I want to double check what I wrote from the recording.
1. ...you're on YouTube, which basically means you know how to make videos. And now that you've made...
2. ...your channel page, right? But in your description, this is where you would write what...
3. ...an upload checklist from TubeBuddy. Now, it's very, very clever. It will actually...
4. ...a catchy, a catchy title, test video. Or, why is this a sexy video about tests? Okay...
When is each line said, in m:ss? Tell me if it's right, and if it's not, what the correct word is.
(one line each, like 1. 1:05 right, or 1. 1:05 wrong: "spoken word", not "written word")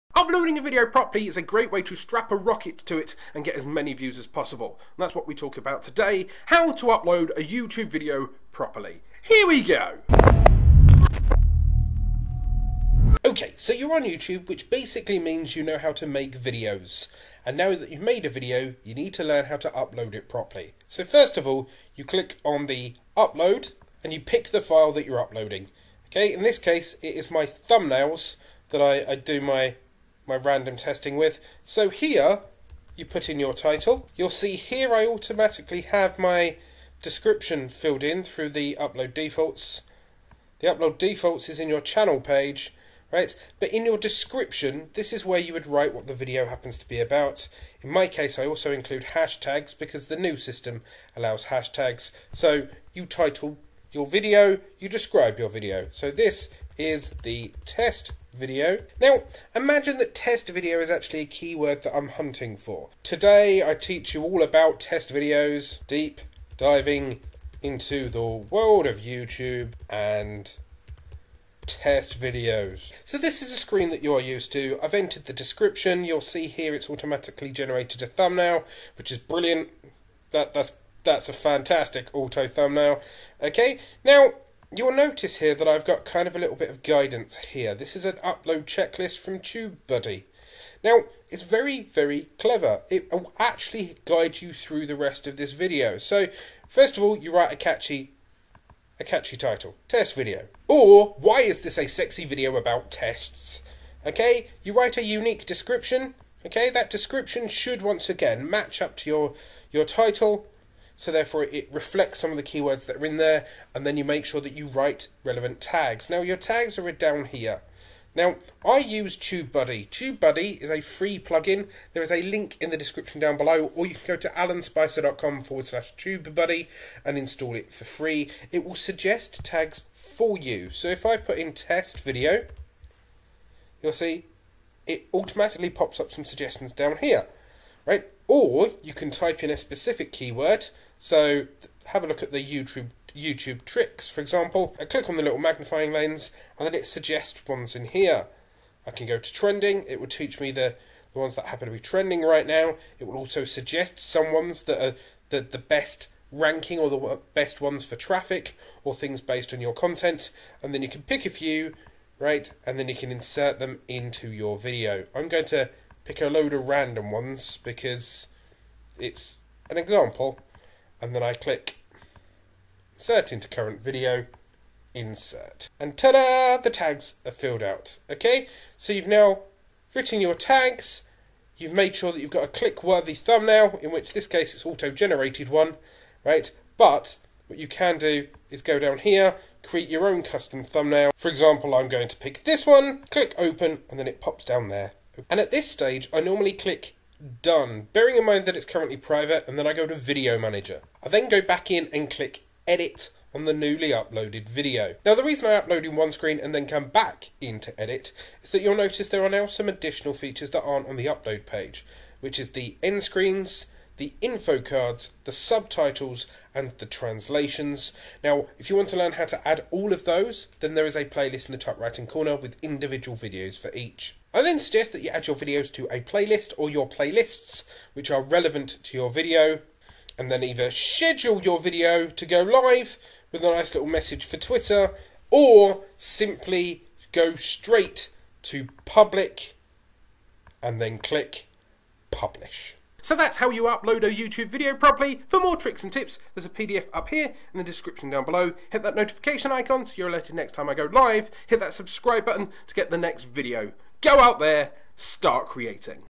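1. 0:13 right
2. 0:41 right
3. 1:28 right
4. 1:37 right.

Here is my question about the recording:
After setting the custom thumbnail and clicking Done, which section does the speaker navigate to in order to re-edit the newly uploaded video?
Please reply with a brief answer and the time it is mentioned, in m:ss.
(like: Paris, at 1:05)
Video Manager, at 3:19.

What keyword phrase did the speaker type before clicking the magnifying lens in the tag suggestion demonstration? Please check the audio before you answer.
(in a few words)
YouTube tricks.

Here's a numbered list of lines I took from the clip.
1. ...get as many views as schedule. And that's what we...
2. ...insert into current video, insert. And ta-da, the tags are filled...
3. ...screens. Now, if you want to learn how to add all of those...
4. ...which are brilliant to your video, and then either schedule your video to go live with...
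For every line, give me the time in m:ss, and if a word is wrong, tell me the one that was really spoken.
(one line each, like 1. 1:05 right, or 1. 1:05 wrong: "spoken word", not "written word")
1. 0:03 wrong: "possible", not "schedule"
2. 2:52 right
3. 3:36 wrong: "translations", not "screens"
4. 3:47 wrong: "relevant", not "brilliant".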